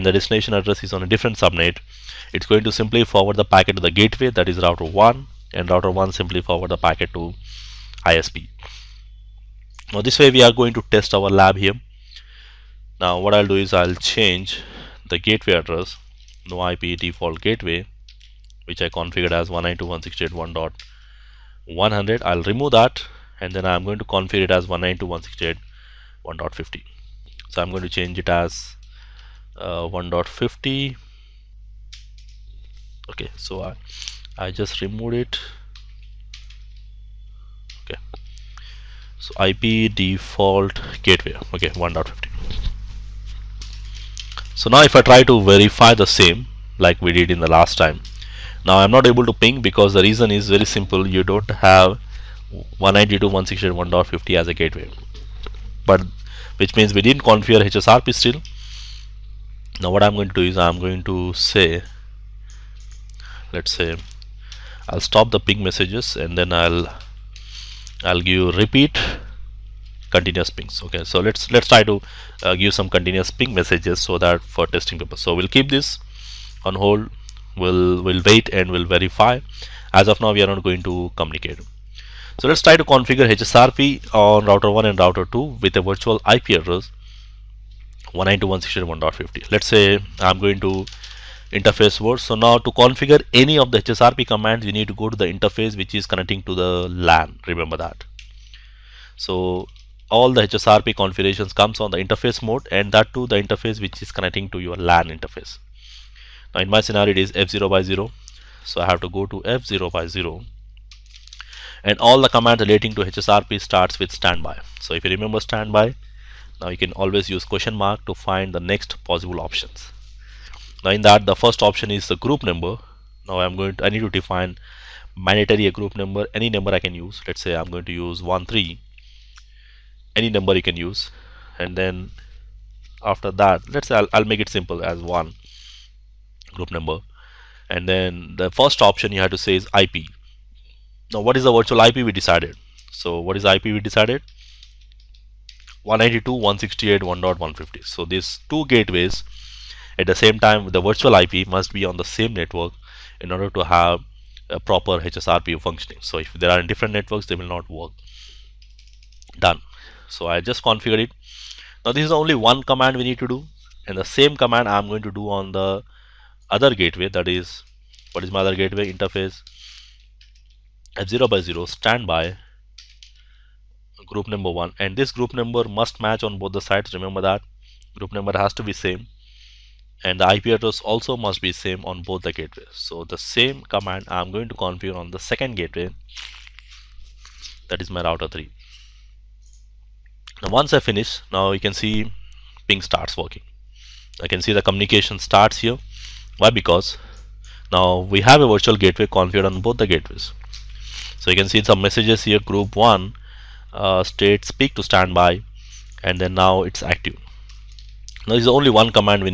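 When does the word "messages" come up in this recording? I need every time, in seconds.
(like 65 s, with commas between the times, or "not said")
65 s, 73 s, 201 s.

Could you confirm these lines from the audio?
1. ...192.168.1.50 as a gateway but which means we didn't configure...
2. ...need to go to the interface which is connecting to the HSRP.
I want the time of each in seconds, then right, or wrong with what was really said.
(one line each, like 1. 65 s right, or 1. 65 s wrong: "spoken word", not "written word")
1. 52 s right
2. 94 s wrong: "LAN", not "HSRP".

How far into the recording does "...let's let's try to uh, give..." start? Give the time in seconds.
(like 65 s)
71 s.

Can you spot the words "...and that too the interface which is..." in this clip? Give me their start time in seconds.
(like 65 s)
102 s.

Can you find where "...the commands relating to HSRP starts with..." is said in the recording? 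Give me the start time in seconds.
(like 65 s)
112 s.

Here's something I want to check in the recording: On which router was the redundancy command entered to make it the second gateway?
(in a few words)
router 3.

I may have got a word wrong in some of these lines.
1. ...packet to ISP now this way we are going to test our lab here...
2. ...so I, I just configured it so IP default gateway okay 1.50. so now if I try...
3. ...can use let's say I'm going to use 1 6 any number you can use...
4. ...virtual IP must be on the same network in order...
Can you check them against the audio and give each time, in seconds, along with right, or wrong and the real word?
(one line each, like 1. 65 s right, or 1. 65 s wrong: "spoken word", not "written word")
1. 6 s right
2. 33 s wrong: "removed", not "configured"
3. 126 s wrong: "3", not "6"
4. 150 s right.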